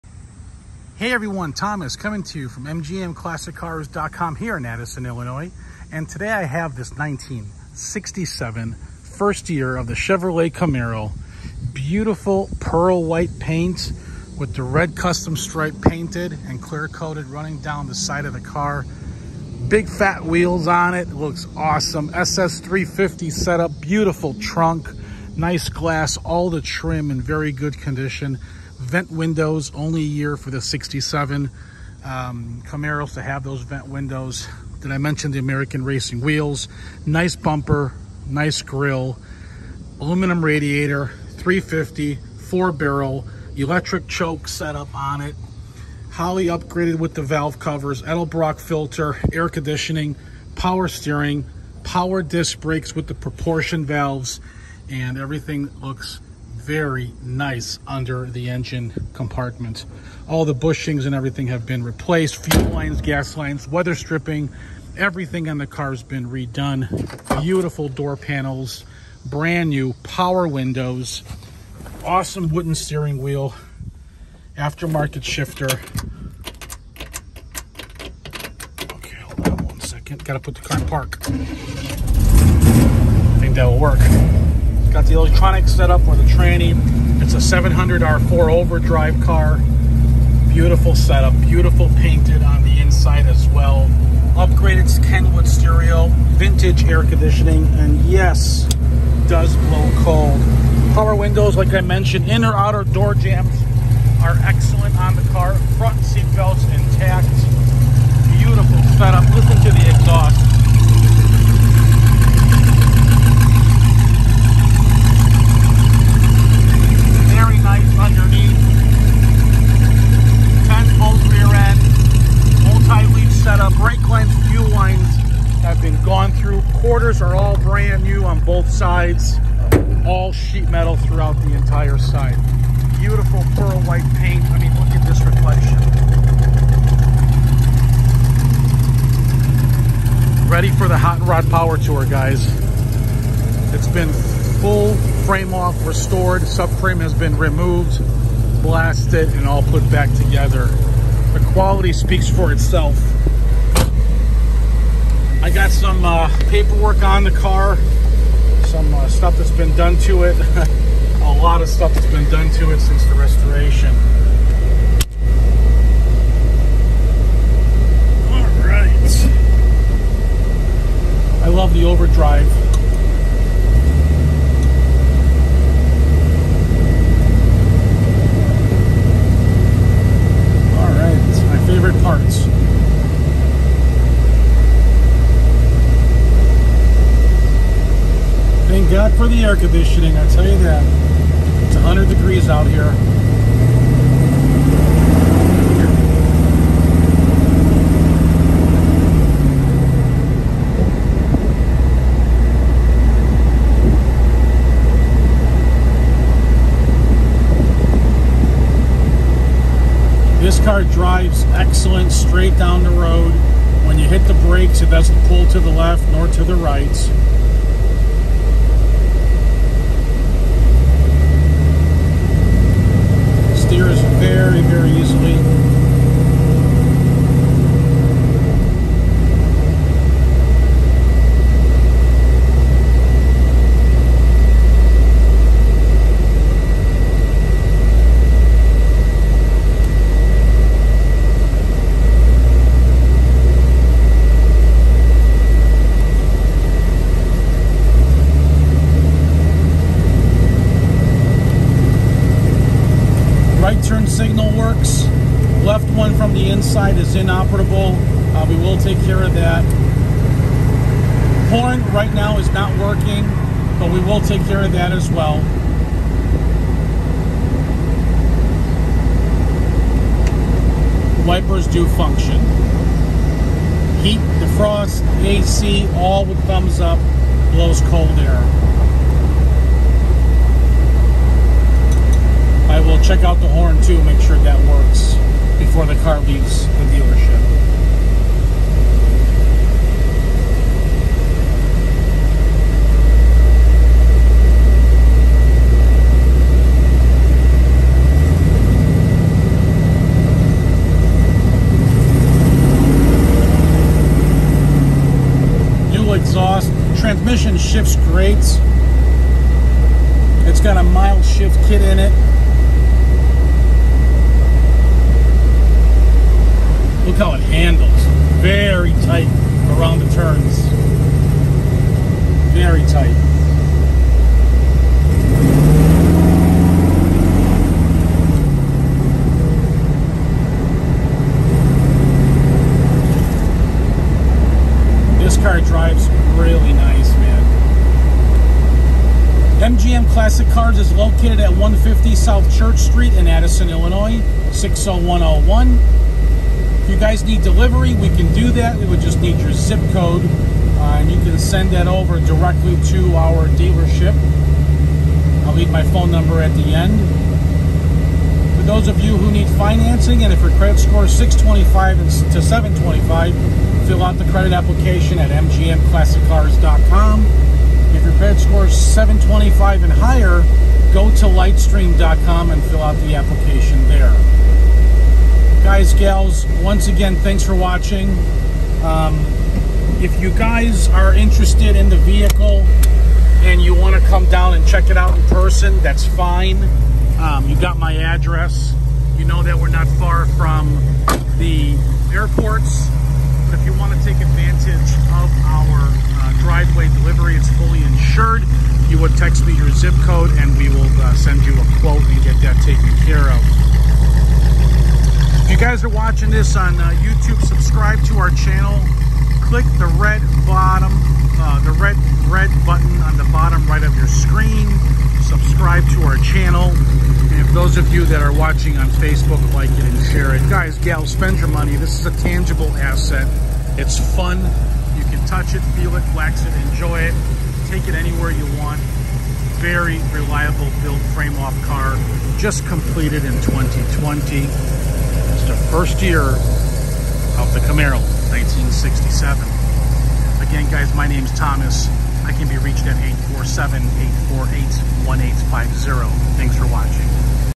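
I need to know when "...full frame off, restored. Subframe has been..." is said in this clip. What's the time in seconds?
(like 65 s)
144 s.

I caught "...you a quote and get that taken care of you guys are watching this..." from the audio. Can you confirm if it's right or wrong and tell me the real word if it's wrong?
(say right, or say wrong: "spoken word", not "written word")
right.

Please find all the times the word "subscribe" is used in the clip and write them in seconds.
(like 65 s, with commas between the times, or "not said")
407 s, 415 s.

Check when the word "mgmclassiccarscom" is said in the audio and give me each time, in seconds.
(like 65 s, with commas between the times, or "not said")
2 s, 365 s.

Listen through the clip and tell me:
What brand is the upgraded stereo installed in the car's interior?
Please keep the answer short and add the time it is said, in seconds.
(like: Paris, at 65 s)
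Kenwood, at 95 s.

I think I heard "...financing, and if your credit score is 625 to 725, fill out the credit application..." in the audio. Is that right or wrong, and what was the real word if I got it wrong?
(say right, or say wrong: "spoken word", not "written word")
right.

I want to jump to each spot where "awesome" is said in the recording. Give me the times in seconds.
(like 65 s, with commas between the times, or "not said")
21 s, 72 s.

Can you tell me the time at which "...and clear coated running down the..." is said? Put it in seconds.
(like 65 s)
16 s.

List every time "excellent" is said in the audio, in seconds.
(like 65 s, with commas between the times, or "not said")
104 s, 211 s.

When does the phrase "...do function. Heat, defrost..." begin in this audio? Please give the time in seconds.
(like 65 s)
271 s.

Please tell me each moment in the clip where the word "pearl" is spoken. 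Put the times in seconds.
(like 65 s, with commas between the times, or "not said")
12 s, 133 s.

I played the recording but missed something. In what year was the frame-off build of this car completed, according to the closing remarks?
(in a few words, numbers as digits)
2020.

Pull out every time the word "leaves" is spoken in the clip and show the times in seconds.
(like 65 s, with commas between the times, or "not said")
286 s, 355 s.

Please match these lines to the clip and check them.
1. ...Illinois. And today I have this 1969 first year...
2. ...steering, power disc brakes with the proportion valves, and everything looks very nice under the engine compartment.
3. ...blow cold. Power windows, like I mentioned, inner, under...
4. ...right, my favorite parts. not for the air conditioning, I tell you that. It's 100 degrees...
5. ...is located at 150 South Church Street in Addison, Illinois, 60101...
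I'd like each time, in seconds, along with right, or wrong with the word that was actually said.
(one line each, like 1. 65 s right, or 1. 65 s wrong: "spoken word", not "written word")
1. 5 s wrong: "1967", not "1969"
2. 50 s right
3. 99 s wrong: "outer", not "under"
4. 180 s right
5. 340 s right.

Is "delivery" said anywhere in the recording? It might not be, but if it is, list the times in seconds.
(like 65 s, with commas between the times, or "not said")
347 s, 396 s.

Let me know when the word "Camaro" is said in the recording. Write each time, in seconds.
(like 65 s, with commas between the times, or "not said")
10 s, 32 s, 437 s.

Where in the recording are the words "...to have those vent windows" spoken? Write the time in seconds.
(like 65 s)
33 s.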